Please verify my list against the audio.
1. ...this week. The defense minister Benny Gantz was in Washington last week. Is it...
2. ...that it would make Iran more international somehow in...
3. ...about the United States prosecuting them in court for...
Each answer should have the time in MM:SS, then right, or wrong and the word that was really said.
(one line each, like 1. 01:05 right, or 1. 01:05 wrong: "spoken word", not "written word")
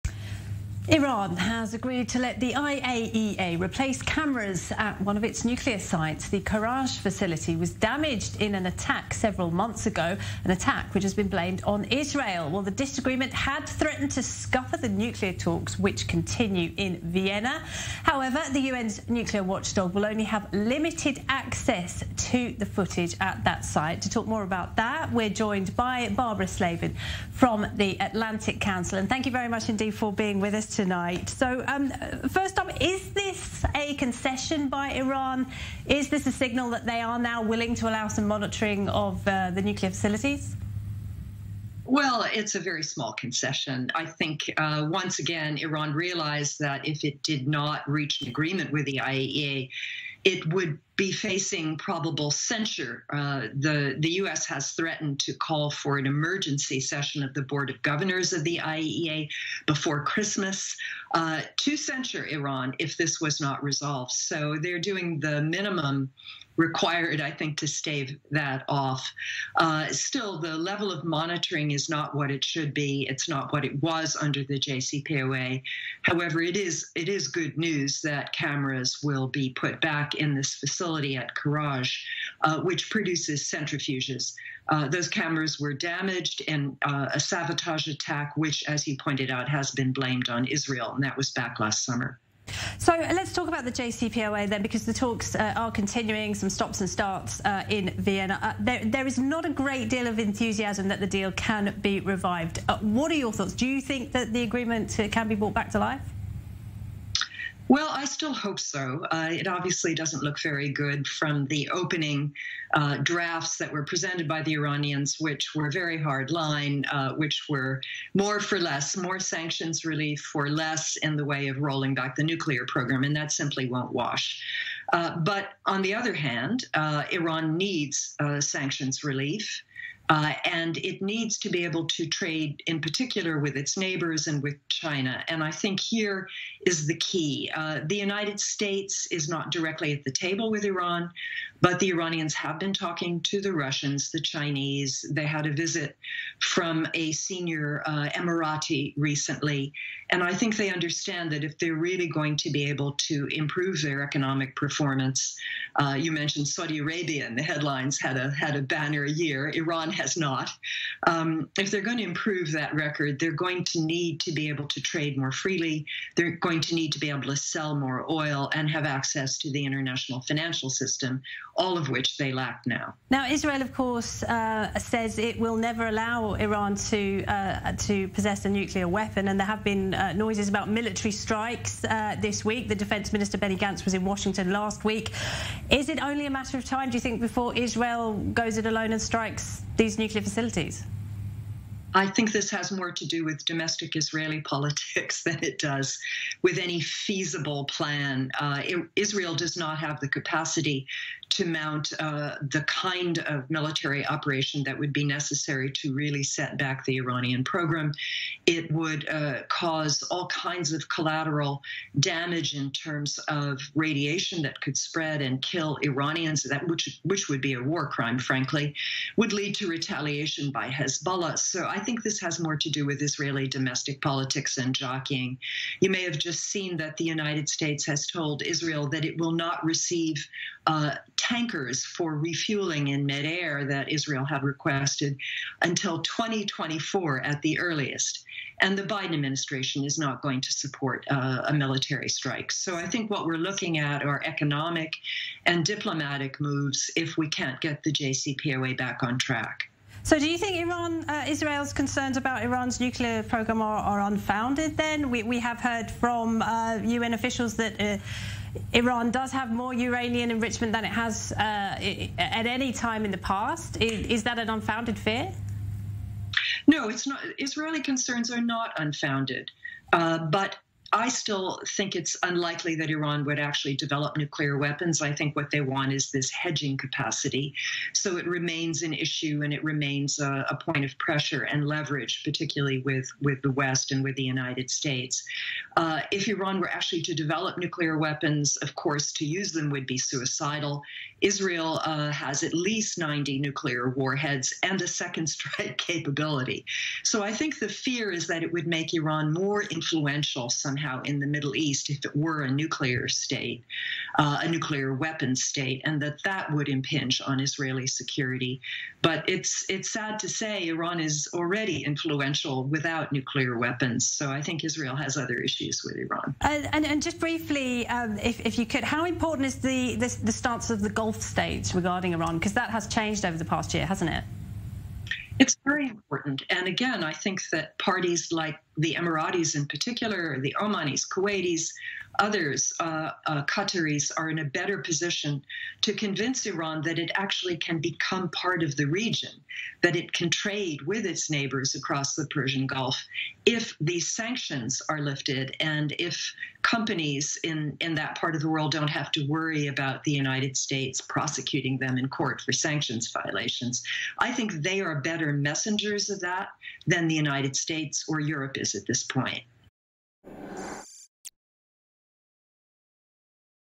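1. 03:02 right
2. 04:58 wrong: "influential", not "international"
3. 05:49 right.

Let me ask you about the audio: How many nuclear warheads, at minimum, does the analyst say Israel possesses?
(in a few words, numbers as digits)
90.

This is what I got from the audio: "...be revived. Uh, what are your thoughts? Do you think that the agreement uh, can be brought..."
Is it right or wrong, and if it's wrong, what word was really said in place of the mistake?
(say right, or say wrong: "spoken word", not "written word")
right.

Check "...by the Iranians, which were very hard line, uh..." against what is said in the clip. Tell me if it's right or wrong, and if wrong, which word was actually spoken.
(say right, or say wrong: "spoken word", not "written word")
right.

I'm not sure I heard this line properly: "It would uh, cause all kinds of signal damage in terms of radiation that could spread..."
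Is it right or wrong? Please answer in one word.
wrong.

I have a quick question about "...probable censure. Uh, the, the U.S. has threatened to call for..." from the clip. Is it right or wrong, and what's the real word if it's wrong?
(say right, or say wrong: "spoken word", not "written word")
right.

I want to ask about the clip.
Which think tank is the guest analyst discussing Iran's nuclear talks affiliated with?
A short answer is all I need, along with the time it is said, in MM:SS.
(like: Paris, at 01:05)
Atlantic Council, at 00:28.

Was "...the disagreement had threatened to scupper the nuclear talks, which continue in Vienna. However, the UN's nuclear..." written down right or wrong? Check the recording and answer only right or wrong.
right.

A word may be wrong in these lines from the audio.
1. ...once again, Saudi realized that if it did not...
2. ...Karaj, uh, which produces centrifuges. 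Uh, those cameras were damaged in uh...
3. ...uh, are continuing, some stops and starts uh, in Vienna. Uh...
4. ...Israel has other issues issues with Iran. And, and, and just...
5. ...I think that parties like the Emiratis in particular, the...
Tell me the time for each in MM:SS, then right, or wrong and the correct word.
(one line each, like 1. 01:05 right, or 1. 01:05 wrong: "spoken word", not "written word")
1. 00:44 wrong: "Iran", not "Saudi"
2. 01:21 right
3. 01:35 right
4. 05:14 right
5. 05:27 right.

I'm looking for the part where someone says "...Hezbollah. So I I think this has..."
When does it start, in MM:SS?
03:40.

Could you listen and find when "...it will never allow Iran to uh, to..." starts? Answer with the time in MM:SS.
02:55.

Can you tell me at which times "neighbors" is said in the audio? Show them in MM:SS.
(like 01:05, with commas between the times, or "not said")
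02:13, 05:41.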